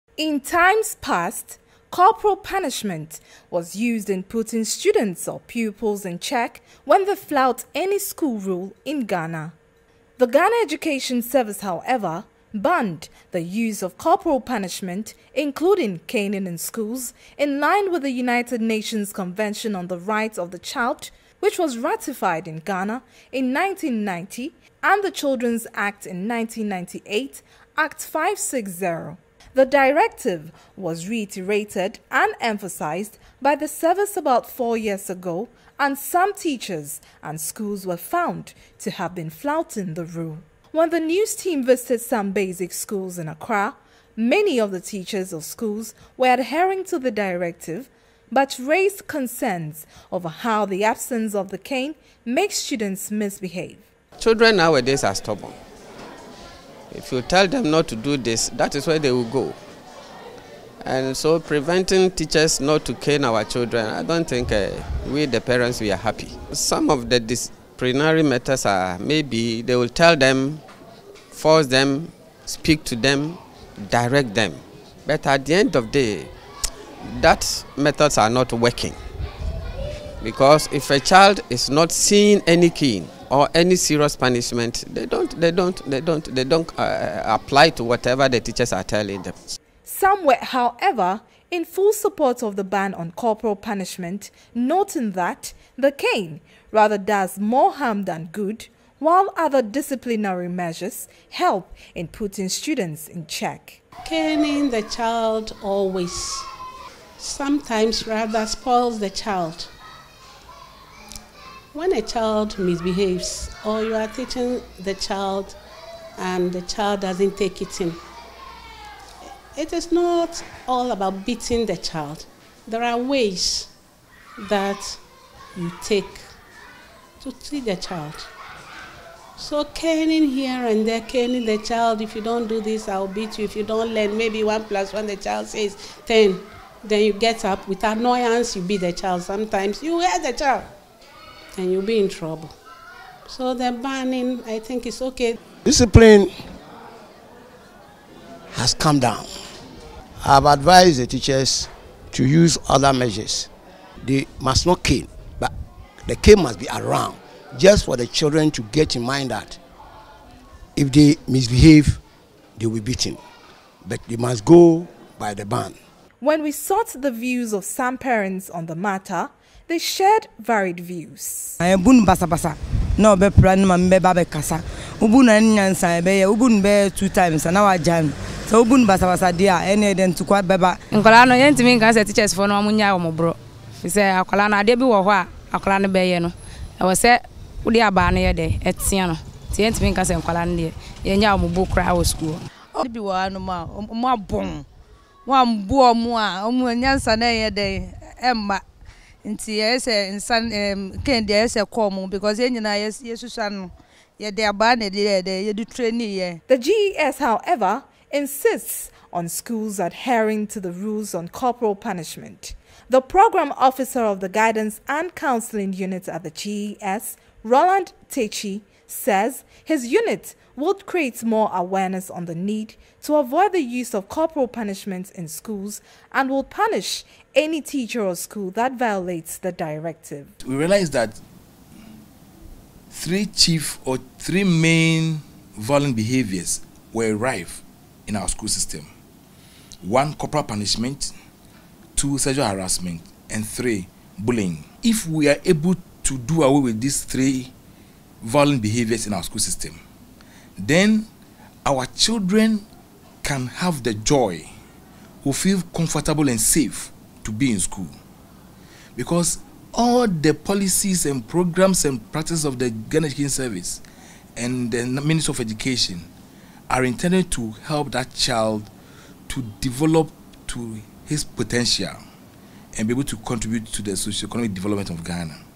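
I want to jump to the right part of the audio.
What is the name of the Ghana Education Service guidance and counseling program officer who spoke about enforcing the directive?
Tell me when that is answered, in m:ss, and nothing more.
3:37.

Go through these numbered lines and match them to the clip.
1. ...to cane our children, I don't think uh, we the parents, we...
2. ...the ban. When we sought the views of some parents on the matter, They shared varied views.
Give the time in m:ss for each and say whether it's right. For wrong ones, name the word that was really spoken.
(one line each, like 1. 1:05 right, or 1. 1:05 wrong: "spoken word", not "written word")
1. 1:02 right
2. 2:45 right.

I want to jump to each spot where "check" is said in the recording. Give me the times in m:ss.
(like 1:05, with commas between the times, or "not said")
0:06, 1:43.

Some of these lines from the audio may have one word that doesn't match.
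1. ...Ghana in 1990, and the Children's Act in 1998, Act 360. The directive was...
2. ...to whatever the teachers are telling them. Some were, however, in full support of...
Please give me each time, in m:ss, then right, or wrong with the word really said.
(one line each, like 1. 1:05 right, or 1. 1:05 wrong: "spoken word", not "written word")
1. 0:22 wrong: "560", not "360"
2. 1:27 right.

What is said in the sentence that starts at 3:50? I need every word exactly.
We realize that three chief or three main violent behaviors were rife in our school system.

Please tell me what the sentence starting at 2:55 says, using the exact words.
Ubu na ni nyansa ẹbẹ yẹ ubu nu two times na wa jam.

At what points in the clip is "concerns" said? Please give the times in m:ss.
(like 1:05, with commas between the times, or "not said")
0:49.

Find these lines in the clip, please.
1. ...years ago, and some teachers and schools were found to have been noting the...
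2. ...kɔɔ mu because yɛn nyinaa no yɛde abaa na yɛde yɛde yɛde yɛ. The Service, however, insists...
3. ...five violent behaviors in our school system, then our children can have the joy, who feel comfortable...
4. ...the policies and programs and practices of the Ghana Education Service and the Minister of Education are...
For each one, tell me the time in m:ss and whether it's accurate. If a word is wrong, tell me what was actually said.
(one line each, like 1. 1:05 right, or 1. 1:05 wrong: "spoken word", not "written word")
1. 0:34 wrong: "flouting", not "noting"
2. 3:21 wrong: "GES", not "Service"
3. 4:07 wrong: "three", not "five"
4. 4:20 right.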